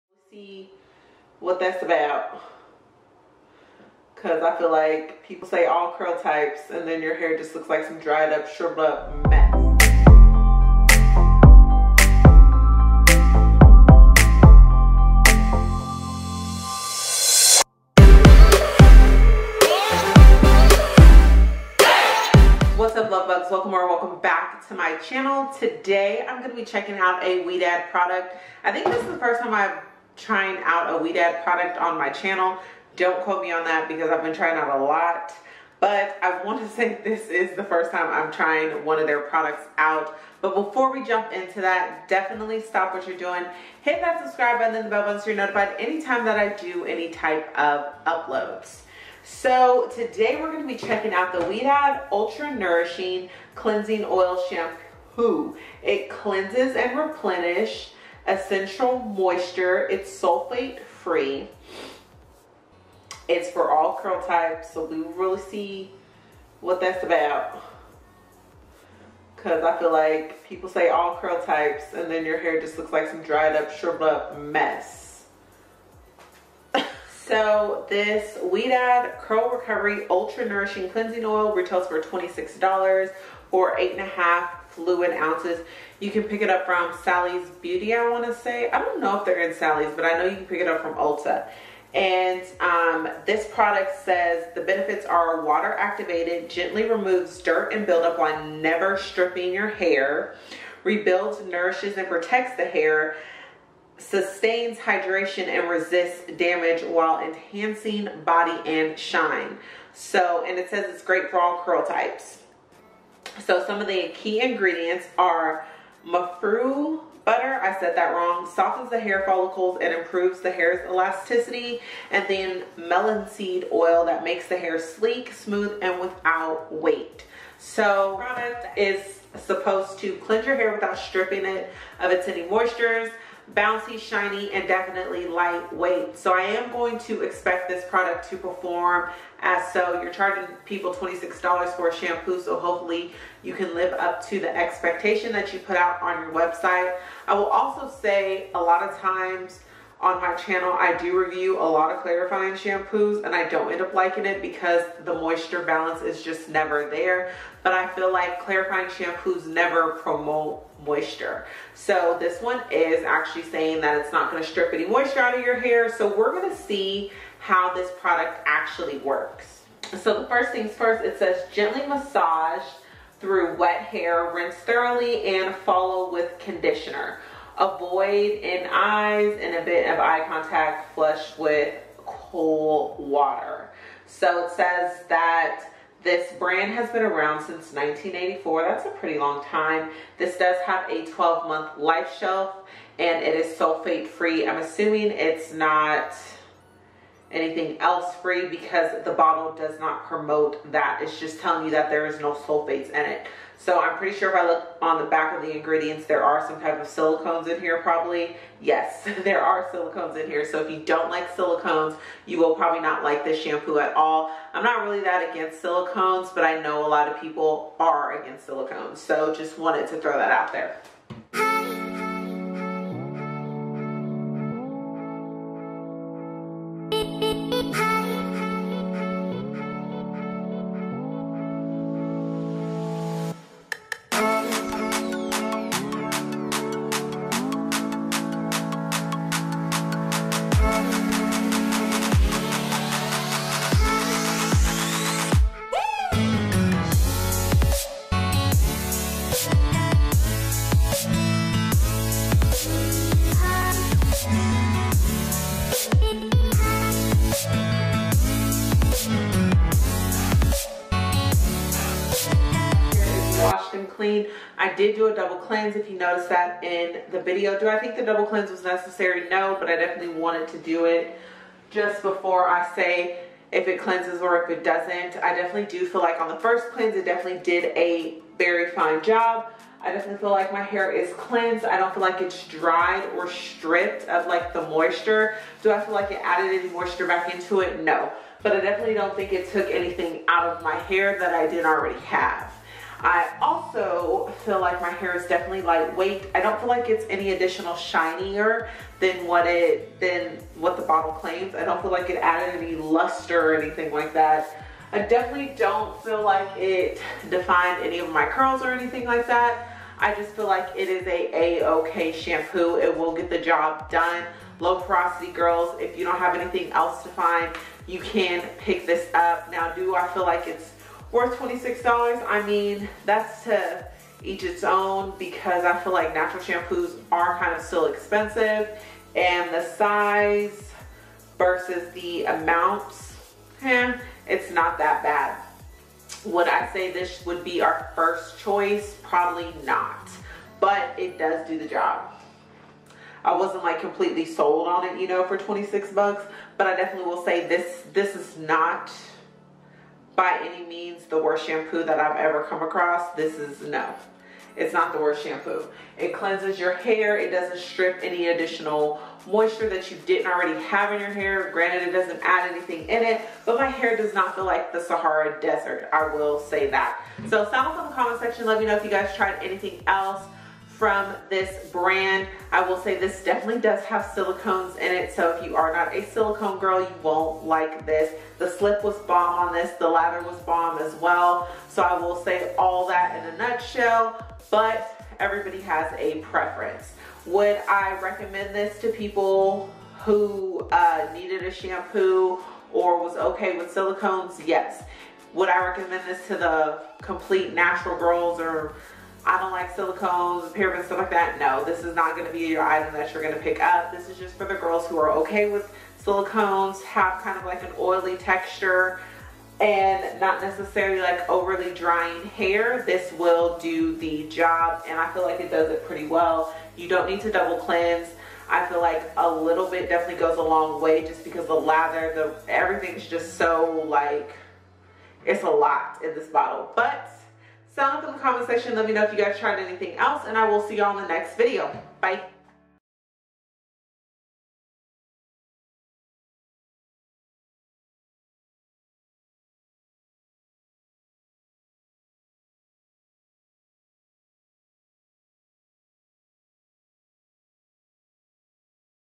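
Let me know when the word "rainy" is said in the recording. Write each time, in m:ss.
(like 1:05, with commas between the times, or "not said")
not said.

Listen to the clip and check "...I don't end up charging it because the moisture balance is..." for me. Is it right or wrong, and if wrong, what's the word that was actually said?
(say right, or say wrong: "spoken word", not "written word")
wrong: "liking", not "charging".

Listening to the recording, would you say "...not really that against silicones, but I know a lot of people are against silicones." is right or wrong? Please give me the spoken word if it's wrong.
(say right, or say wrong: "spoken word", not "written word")
right.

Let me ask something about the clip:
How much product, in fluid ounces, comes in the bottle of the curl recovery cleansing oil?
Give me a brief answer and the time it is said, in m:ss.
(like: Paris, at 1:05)
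8.5 fluid ounces, at 1:23.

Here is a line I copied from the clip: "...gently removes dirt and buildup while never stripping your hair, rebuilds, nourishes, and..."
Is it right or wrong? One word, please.
right.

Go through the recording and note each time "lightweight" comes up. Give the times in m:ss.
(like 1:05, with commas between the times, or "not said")
2:15, 4:55.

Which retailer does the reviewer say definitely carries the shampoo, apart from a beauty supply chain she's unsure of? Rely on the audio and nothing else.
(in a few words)
Ulta.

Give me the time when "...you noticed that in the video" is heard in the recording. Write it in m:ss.
4:25.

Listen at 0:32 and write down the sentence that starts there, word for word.
Don't quote me on that because I've been trying out a lot.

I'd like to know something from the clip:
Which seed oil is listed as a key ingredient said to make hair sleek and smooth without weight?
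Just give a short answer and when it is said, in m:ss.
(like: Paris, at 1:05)
Melon seed oil, at 2:02.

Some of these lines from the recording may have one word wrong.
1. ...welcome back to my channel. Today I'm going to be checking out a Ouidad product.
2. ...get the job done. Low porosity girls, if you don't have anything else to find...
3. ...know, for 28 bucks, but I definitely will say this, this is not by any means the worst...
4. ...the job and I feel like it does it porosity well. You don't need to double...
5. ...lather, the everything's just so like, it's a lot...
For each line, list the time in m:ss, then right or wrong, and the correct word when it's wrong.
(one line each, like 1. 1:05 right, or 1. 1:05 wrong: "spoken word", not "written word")
1. 0:23 right
2. 5:13 right
3. 5:45 wrong: "26", not "28"
4. 6:53 wrong: "pretty", not "porosity"
5. 7:01 right.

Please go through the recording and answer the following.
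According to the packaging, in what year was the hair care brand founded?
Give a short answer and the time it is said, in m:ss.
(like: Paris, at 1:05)
1984, at 3:07.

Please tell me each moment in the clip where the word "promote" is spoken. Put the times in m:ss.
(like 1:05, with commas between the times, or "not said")
2:40, 3:20.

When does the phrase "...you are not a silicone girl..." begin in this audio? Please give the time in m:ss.
6:15.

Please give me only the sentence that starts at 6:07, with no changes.
So sound off in the comment section.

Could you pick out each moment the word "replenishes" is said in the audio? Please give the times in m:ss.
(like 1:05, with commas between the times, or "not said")
0:56.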